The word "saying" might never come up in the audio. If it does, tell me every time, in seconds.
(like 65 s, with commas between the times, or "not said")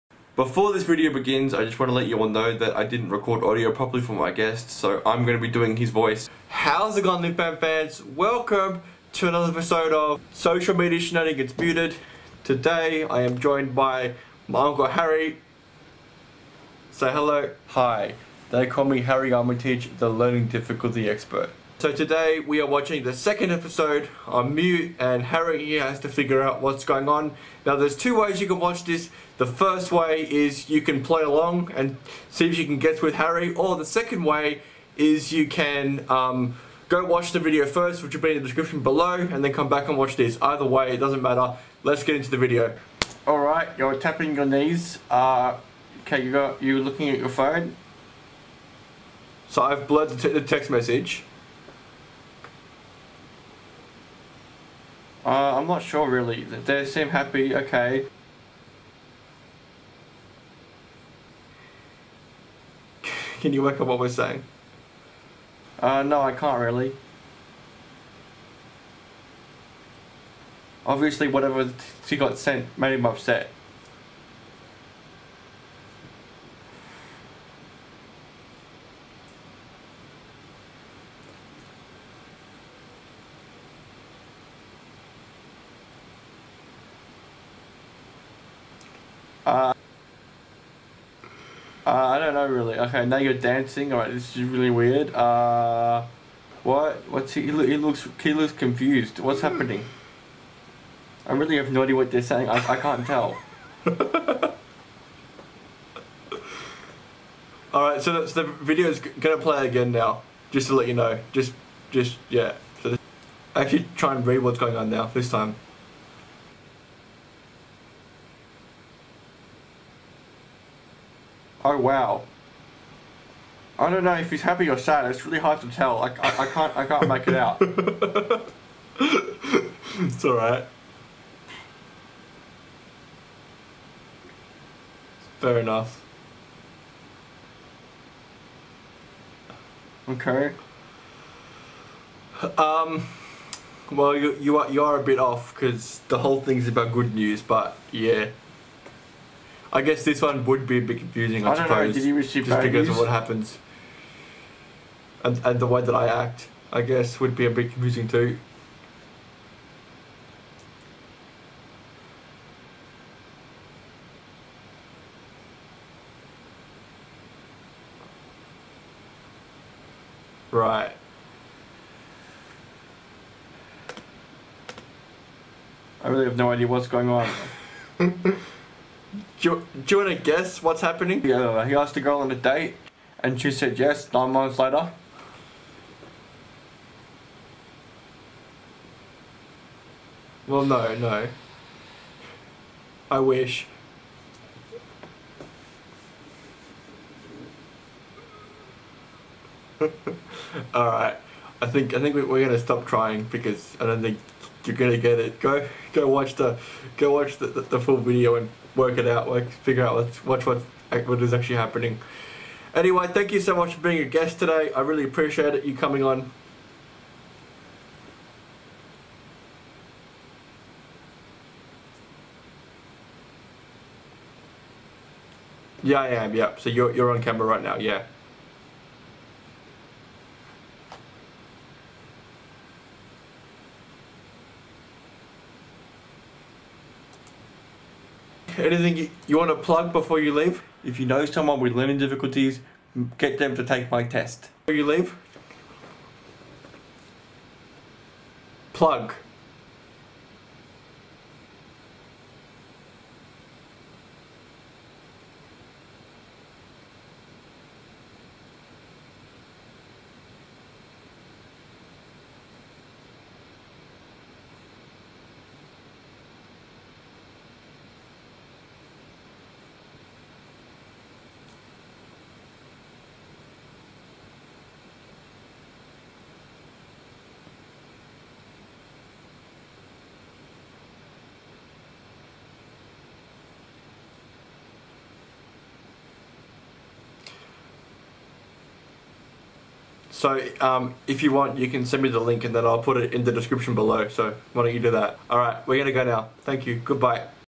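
64 s, 102 s.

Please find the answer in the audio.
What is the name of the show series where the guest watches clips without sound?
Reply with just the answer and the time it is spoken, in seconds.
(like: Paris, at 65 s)
Social Media Shenanigans Muted, at 10 s.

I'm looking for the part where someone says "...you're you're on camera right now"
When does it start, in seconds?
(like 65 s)
226 s.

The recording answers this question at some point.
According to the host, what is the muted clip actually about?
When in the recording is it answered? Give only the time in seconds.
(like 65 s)
146 s.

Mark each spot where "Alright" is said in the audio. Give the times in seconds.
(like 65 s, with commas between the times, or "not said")
43 s, 93 s, 107 s.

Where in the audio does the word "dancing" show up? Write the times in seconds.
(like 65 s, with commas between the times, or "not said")
93 s.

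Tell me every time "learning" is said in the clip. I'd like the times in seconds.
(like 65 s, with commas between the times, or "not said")
20 s, 241 s.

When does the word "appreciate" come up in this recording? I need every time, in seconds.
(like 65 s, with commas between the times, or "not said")
215 s.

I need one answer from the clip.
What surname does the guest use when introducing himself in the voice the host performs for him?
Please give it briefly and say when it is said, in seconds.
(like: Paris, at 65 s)
Armytage, at 19 s.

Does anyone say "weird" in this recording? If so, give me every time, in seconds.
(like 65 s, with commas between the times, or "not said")
94 s.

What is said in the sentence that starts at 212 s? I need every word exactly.
Anyway, thank you so much for being a guest today.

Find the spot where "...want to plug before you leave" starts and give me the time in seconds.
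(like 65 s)
239 s.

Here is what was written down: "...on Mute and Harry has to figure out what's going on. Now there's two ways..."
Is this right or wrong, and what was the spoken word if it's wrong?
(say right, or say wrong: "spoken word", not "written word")
right.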